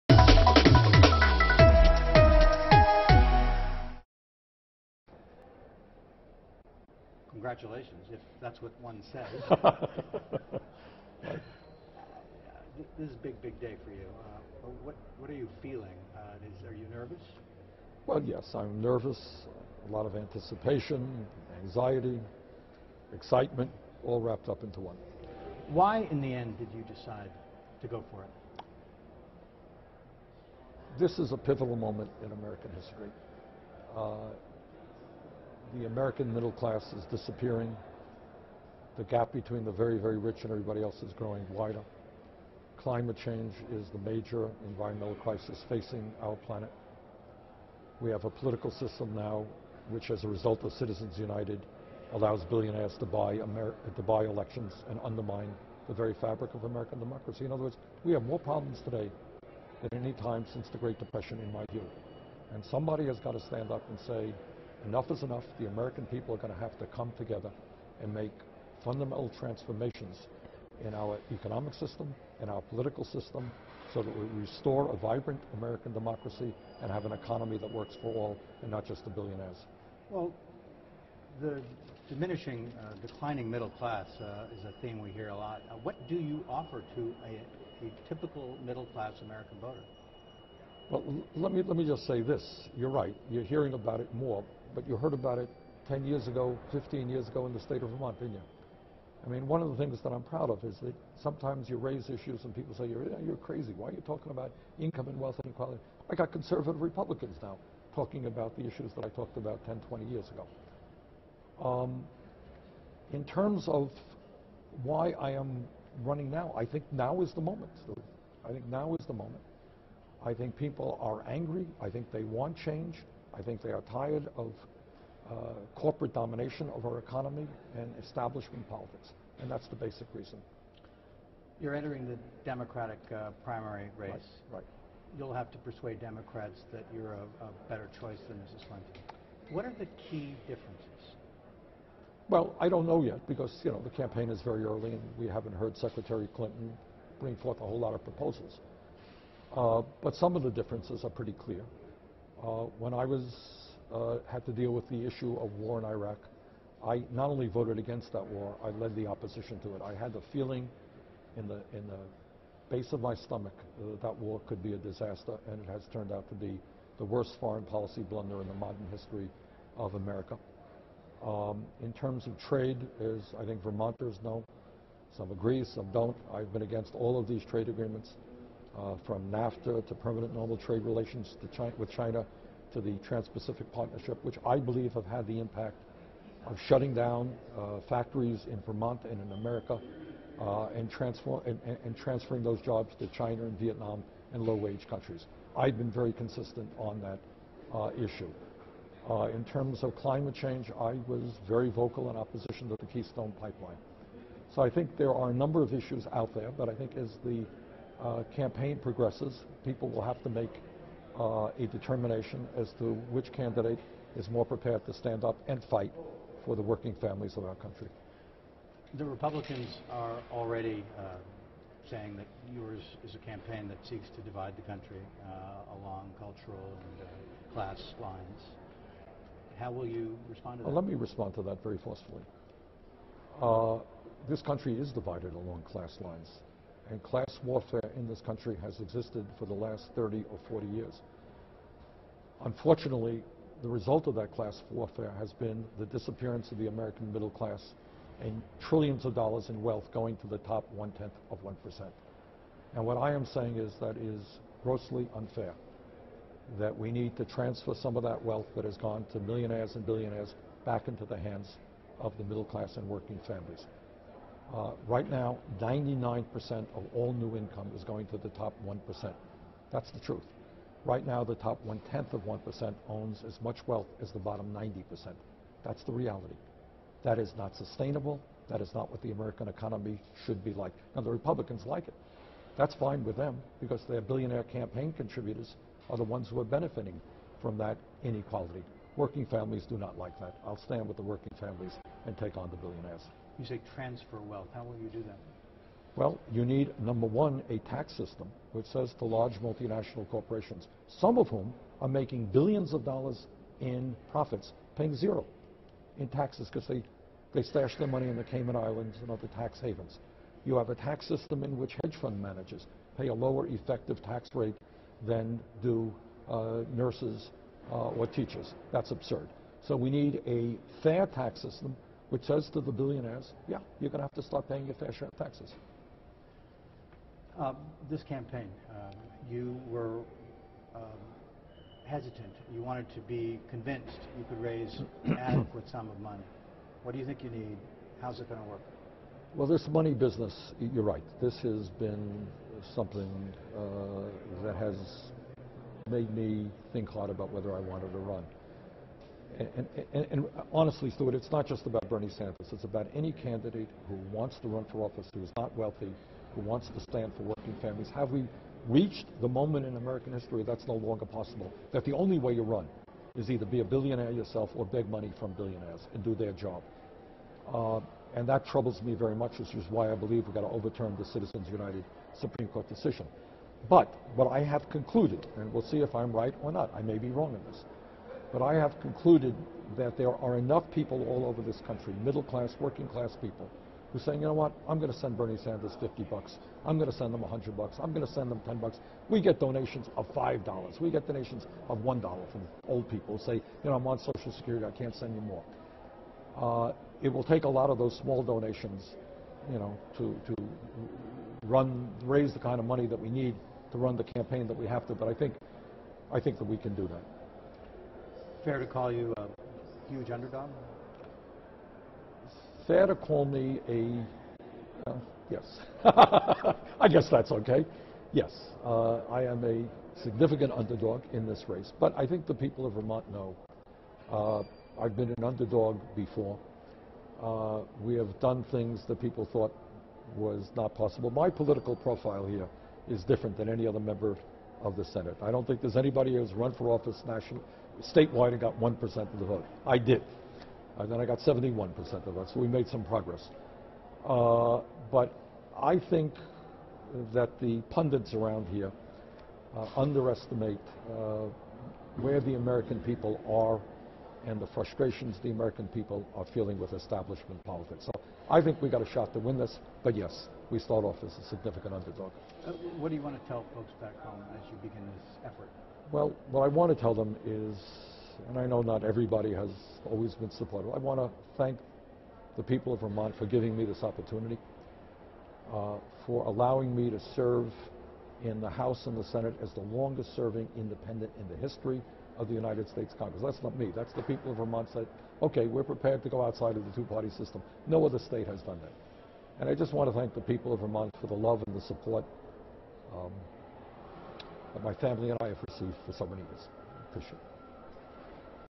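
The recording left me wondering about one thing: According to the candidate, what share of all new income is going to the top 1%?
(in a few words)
99%.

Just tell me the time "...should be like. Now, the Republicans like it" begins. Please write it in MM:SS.
04:40.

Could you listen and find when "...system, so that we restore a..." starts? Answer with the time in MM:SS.
01:13.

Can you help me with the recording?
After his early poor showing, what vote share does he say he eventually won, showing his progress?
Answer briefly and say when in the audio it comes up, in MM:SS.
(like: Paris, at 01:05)
71%, at 07:21.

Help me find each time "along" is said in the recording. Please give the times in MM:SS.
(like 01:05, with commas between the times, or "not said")
03:45, 03:55.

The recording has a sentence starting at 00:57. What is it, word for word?
In other words, we have more problems today than any time since the Great Depression, in my view.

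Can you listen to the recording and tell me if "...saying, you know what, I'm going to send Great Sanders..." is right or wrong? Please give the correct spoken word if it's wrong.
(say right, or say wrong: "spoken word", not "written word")
wrong: "Bernie", not "Great".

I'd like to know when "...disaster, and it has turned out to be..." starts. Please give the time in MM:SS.
02:44.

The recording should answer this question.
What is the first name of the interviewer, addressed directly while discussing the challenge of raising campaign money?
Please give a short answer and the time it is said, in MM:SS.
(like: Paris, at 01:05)
Stewart, at 05:50.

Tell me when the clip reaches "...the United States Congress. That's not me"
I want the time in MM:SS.
08:02.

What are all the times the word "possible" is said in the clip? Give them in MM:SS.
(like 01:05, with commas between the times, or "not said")
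06:01, 07:10.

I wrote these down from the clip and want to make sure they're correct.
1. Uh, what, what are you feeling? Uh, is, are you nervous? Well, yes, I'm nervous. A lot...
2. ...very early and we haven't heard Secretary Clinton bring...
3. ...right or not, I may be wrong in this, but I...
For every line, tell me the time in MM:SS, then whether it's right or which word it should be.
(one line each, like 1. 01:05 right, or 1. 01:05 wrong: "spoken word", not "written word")
1. 00:14 right
2. 02:24 right
3. 06:16 right.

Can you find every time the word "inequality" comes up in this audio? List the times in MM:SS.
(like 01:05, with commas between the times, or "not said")
01:45, 04:48.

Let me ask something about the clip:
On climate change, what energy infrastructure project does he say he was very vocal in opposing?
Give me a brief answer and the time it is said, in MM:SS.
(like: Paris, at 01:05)
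Keystone Pipeline, at 03:22.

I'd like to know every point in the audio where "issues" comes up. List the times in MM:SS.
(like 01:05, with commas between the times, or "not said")
01:42, 01:48, 02:35, 03:17, 03:25.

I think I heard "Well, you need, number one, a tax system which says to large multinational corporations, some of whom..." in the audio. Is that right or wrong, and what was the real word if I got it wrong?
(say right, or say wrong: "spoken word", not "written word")
right.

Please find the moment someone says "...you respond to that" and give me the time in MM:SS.
03:49.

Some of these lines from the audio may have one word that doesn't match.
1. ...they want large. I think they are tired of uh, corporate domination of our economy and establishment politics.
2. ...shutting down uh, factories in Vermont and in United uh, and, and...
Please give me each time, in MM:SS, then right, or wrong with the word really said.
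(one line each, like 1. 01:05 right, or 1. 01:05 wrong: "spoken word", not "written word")
1. 02:02 wrong: "change", not "large"
2. 03:06 wrong: "America", not "United".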